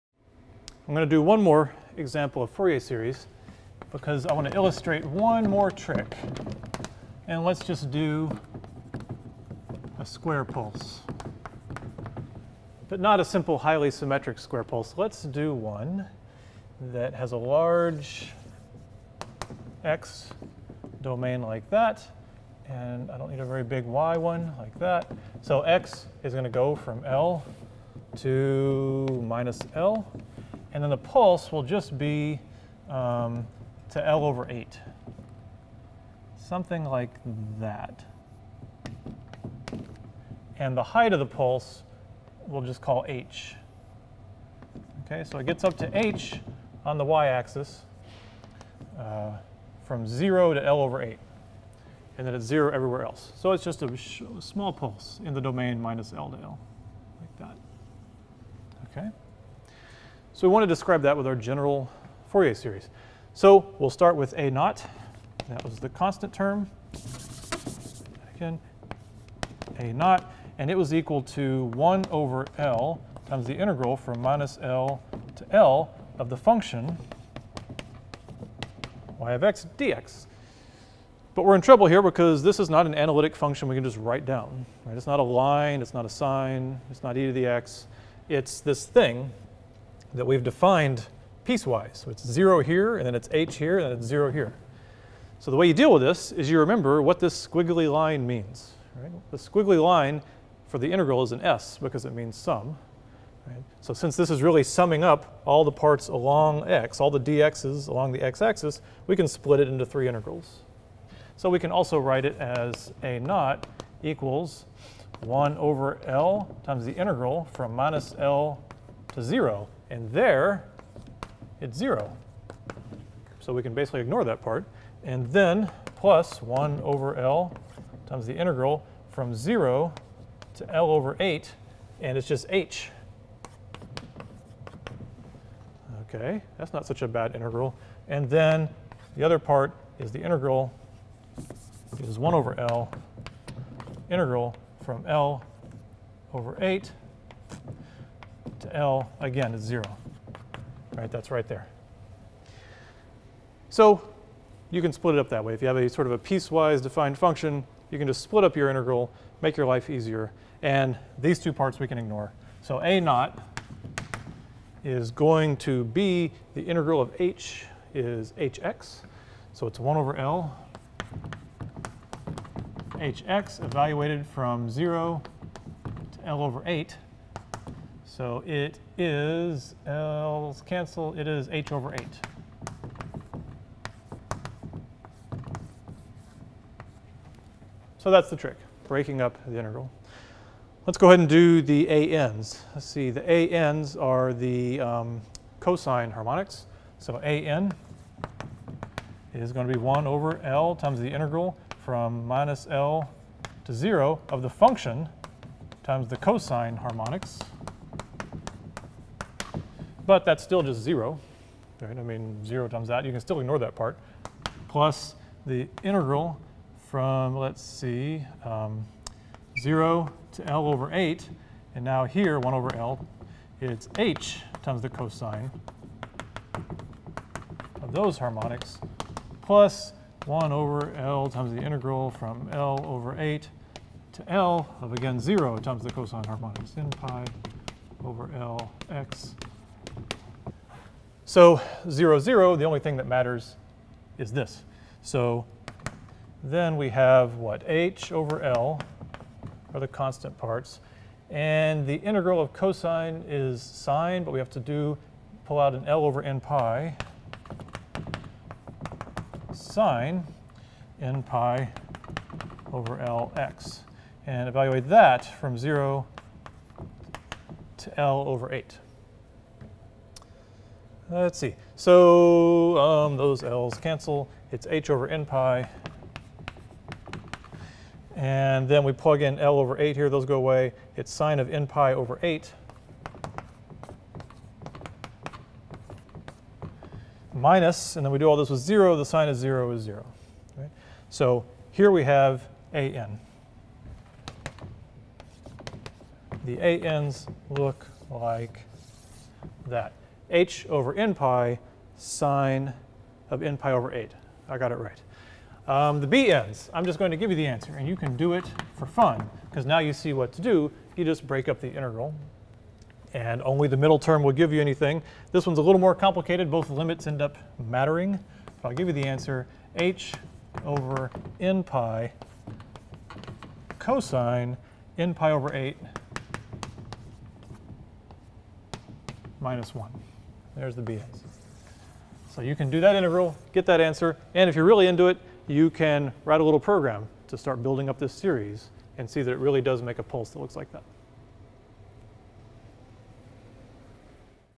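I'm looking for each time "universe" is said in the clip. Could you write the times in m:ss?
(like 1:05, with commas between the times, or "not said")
not said.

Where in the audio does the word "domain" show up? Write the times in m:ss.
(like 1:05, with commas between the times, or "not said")
0:21, 0:55.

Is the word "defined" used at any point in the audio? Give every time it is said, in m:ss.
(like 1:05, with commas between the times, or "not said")
1:30, 2:36.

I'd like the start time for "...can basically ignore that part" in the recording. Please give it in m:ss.
2:03.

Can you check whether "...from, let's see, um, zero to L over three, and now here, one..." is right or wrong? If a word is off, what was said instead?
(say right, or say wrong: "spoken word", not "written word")
wrong: "eight", not "three".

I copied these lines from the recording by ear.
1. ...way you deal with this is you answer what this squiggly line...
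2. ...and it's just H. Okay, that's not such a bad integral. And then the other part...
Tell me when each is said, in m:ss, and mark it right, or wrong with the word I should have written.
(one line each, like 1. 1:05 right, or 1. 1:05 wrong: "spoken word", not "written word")
1. 1:35 wrong: "remember", not "answer"
2. 2:11 right.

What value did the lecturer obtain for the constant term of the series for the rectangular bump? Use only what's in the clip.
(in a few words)
h/8.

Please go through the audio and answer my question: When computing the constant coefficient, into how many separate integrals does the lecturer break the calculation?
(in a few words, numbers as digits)
3.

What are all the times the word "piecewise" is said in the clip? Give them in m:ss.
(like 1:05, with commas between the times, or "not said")
1:31, 2:36.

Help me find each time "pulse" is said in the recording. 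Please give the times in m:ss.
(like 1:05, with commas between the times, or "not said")
0:10, 0:14, 0:30, 0:41, 0:54, 5:40.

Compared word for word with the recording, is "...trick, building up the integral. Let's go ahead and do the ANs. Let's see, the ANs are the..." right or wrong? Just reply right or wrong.
wrong.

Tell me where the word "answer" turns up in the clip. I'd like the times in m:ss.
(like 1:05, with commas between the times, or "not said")
5:07, 5:19, 5:33.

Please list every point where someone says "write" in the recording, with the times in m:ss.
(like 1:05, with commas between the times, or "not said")
1:23, 1:51, 5:36.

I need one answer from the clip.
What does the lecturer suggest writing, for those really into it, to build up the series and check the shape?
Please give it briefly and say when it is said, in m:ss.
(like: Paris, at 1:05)
a little program, at 5:36.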